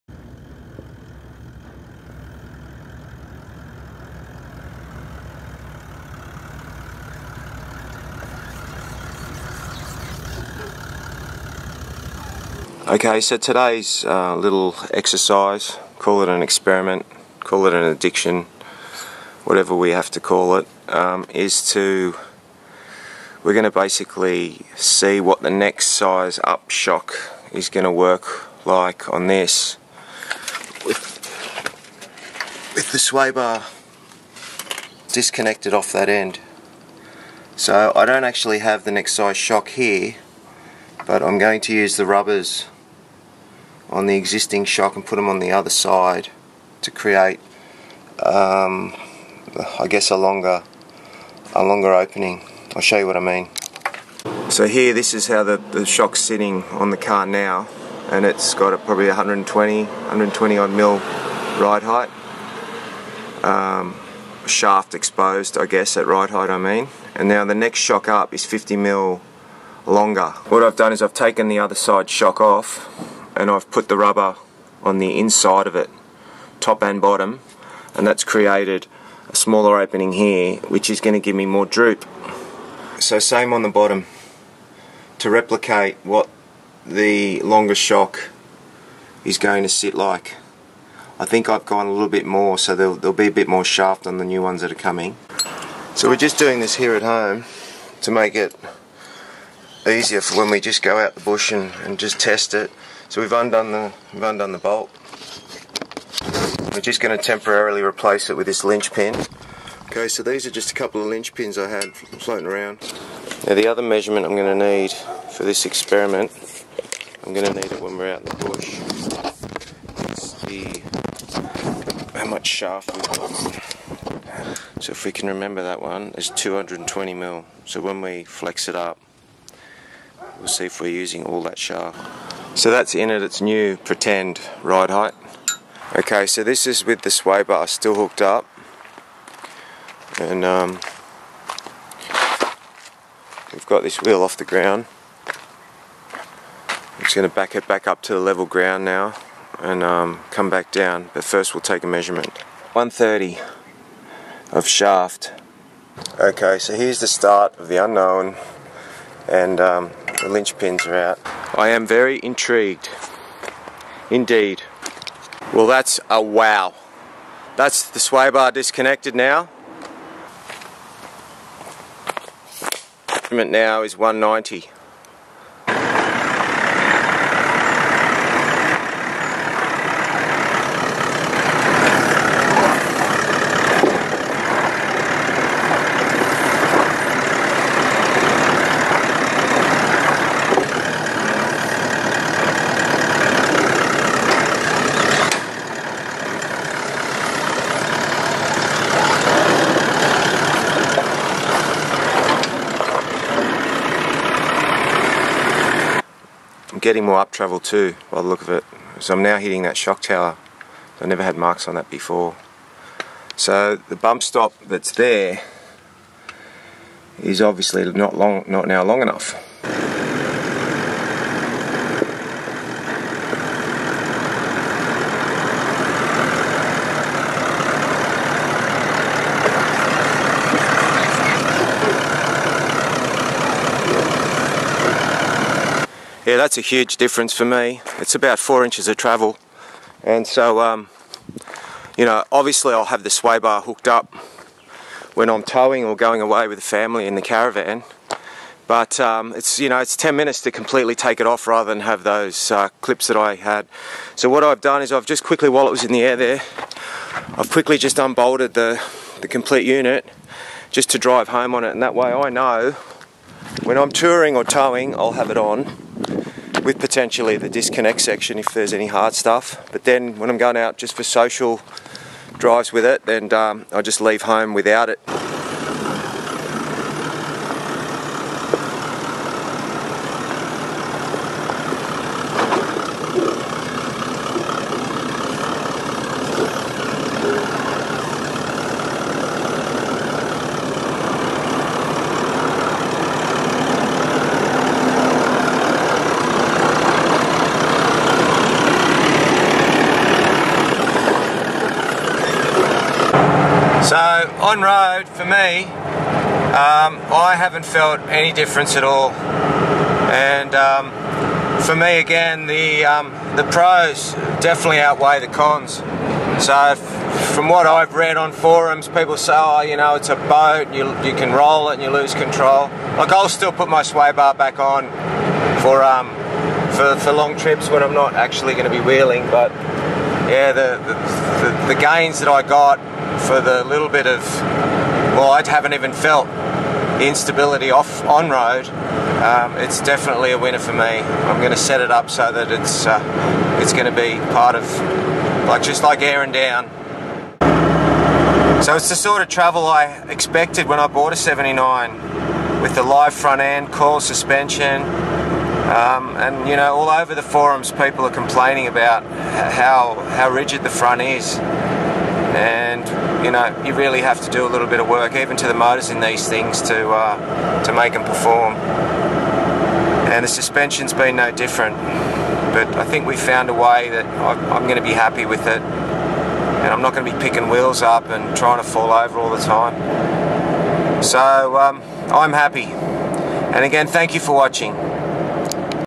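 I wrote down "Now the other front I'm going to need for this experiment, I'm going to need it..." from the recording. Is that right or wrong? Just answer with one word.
wrong.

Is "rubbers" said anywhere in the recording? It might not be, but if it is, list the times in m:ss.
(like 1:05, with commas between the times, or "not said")
0:42, 1:13.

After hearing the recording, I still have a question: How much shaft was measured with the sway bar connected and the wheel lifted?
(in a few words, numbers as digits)
130.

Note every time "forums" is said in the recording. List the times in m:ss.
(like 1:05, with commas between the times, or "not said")
5:18, 5:57.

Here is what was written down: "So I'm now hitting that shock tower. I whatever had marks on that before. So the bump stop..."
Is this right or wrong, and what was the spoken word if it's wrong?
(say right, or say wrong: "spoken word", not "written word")
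wrong: "never", not "whatever".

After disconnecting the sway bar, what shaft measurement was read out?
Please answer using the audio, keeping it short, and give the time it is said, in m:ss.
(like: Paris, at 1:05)
190, at 2:53.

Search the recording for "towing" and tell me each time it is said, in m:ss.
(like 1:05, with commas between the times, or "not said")
4:05, 4:24.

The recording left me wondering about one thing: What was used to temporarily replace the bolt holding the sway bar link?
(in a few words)
linch pin.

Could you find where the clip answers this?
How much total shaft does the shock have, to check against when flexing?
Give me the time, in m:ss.
2:06.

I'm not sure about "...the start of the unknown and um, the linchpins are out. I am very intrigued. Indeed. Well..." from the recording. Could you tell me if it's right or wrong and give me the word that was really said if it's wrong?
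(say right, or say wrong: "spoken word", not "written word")
right.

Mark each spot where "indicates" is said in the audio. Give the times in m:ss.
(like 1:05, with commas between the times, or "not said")
not said.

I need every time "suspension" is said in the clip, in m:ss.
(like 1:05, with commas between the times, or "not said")
5:53, 6:10.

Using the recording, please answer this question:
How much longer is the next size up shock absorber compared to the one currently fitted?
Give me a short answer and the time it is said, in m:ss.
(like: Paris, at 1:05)
50 mm, at 1:08.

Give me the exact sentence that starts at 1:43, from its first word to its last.
So we've undone the, we've undone the bolt.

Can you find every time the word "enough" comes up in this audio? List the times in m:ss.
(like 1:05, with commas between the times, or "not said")
3:39.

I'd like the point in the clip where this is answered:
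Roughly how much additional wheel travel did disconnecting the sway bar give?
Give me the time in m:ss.
3:58.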